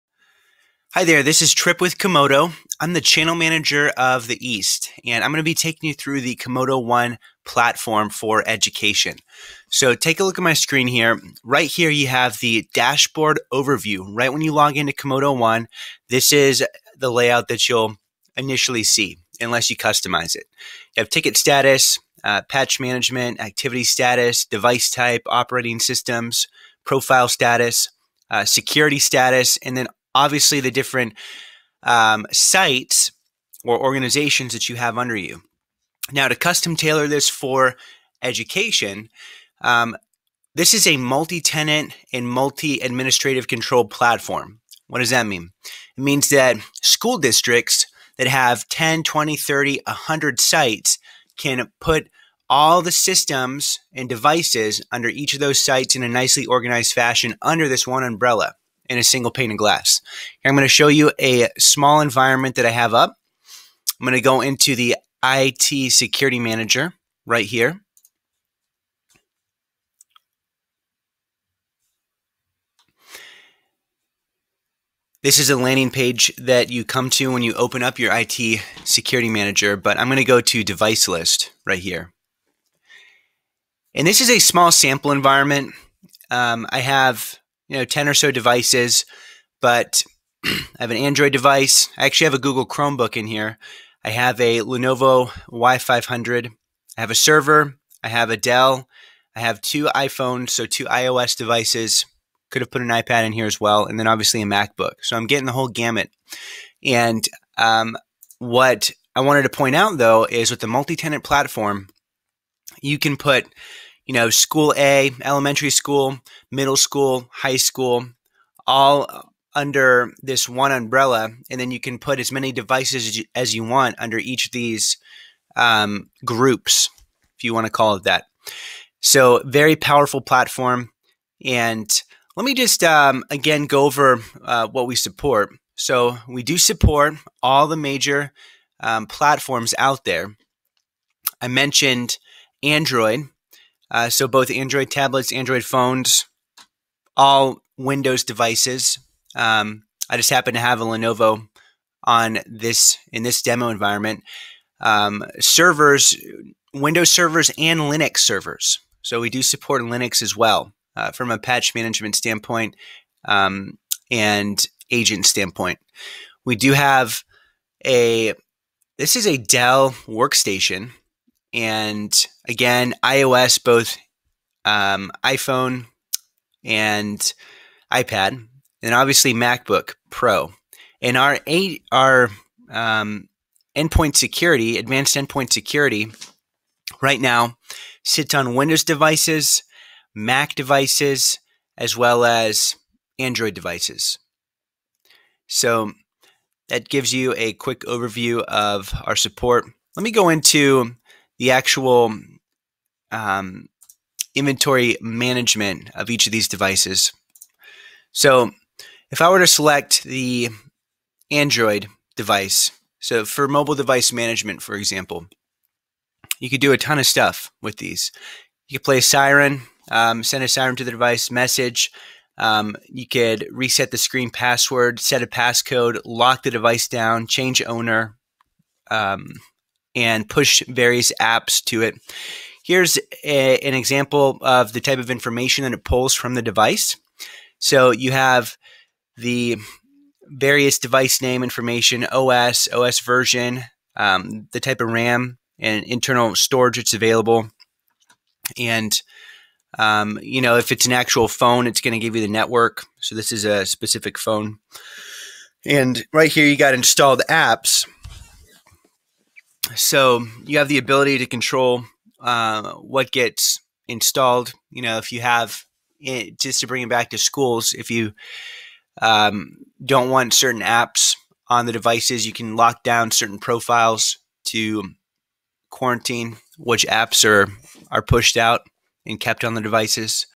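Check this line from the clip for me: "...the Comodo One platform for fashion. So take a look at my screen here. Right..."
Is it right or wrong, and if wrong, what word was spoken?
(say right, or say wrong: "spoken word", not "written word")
wrong: "education", not "fashion".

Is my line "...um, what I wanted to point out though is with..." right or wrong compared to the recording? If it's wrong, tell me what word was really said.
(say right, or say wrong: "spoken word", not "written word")
right.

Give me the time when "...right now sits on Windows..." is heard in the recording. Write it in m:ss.
3:07.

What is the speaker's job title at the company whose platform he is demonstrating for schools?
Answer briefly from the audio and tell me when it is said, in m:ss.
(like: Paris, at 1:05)
Channel manager of the East, at 0:02.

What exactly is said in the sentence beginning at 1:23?
And this is a small sample environment.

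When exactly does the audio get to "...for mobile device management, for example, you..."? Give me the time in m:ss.
3:33.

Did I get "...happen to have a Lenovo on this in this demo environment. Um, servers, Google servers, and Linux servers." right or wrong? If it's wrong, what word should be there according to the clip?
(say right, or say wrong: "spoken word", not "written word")
wrong: "Windows", not "Google".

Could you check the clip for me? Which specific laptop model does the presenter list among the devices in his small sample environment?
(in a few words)
Lenovo Y500.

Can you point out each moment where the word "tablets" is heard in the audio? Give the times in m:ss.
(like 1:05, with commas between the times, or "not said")
2:24.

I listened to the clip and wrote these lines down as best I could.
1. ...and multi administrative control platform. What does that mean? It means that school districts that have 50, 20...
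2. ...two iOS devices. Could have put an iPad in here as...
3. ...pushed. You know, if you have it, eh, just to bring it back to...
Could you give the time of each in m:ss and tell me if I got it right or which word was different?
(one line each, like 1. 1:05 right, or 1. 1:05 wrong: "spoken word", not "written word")
1. 0:42 wrong: "10", not "50"
2. 1:40 right
3. 4:23 wrong: "installed", not "pushed".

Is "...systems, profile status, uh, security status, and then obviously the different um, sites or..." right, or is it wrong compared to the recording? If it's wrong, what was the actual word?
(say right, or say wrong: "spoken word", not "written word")
right.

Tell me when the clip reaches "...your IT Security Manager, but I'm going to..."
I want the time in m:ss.
1:17.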